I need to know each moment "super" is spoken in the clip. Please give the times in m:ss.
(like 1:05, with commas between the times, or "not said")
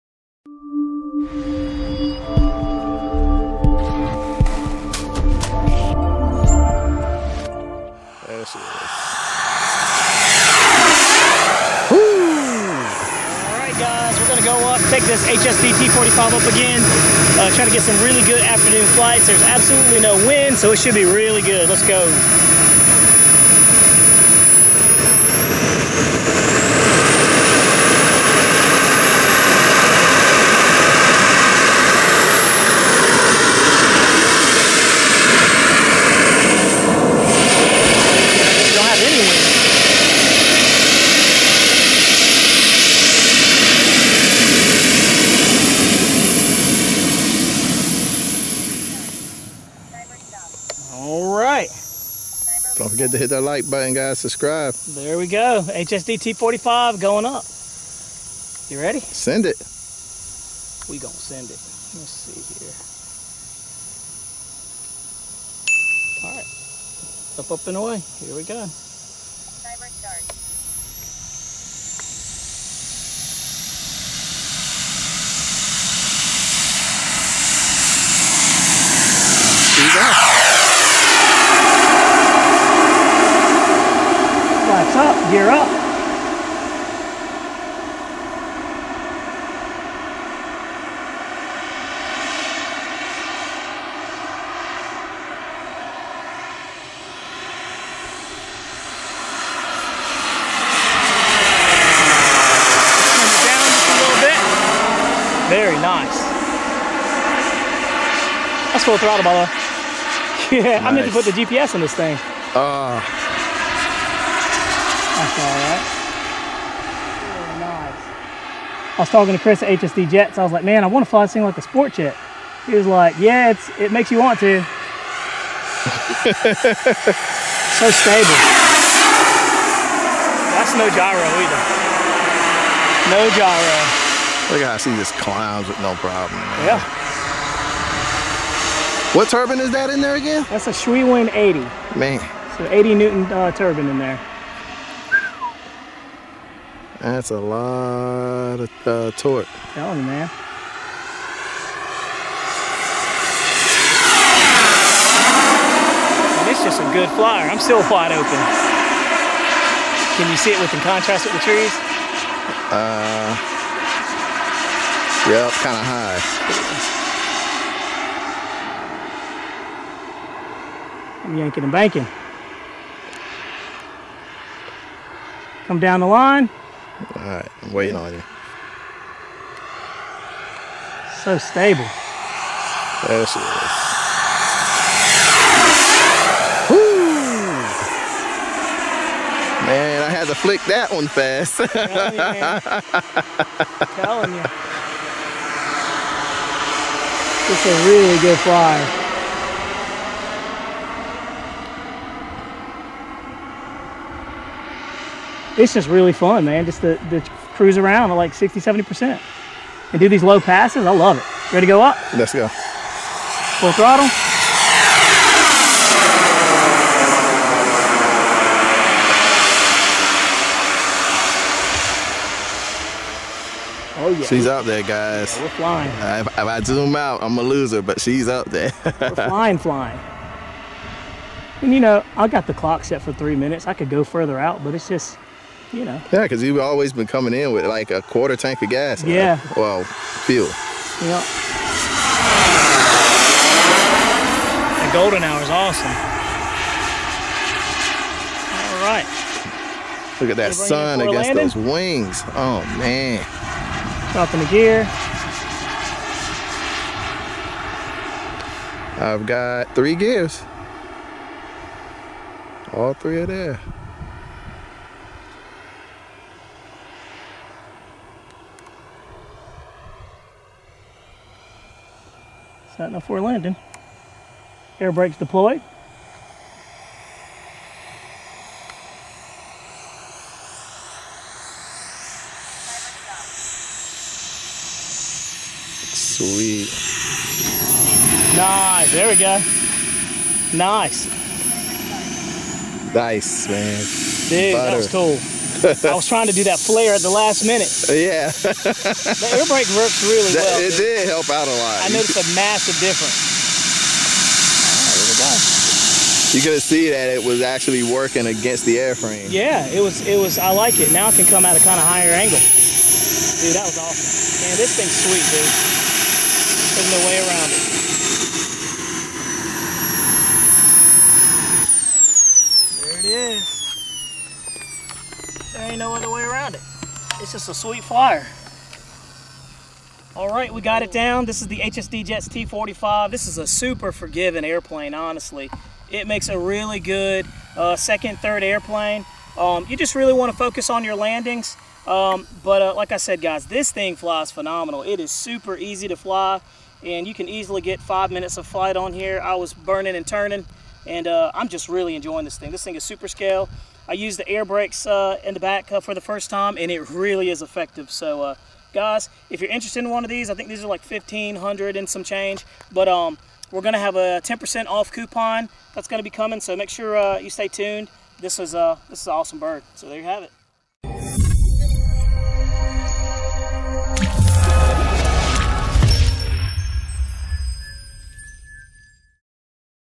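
5:33, 5:45, 5:52.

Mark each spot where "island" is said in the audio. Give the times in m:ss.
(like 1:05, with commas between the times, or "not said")
not said.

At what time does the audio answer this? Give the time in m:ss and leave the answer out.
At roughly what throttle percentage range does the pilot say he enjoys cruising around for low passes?
3:28.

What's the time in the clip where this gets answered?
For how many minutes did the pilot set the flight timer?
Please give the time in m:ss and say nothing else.
3:53.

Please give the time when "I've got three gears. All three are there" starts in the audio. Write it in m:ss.
4:19.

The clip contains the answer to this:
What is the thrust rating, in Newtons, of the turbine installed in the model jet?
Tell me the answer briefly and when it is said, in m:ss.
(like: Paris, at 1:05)
80, at 2:22.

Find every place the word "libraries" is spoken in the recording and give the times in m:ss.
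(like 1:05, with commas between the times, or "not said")
not said.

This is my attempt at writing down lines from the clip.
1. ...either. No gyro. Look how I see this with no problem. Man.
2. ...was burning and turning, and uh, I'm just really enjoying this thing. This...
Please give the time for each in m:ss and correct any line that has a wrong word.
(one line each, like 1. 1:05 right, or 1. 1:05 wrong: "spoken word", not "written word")
1. 2:11 right
2. 5:49 right.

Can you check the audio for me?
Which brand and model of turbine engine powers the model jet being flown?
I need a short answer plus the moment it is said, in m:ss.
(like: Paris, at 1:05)
Swiwin 80, at 2:20.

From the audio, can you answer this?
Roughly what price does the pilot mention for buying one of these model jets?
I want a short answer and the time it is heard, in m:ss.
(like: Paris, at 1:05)
1500, at 6:00.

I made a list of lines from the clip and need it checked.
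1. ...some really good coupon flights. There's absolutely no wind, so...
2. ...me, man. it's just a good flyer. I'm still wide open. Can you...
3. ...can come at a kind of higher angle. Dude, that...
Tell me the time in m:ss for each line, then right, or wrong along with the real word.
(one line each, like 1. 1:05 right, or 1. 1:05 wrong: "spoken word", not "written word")
1. 0:17 wrong: "afternoon", not "coupon"
2. 2:29 right
3. 5:11 right.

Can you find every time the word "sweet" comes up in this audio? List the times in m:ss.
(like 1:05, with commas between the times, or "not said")
4:45, 5:14, 5:27.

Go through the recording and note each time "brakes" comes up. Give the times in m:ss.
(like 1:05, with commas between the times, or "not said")
4:34, 4:59, 5:54.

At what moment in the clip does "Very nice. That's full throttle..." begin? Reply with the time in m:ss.
1:45.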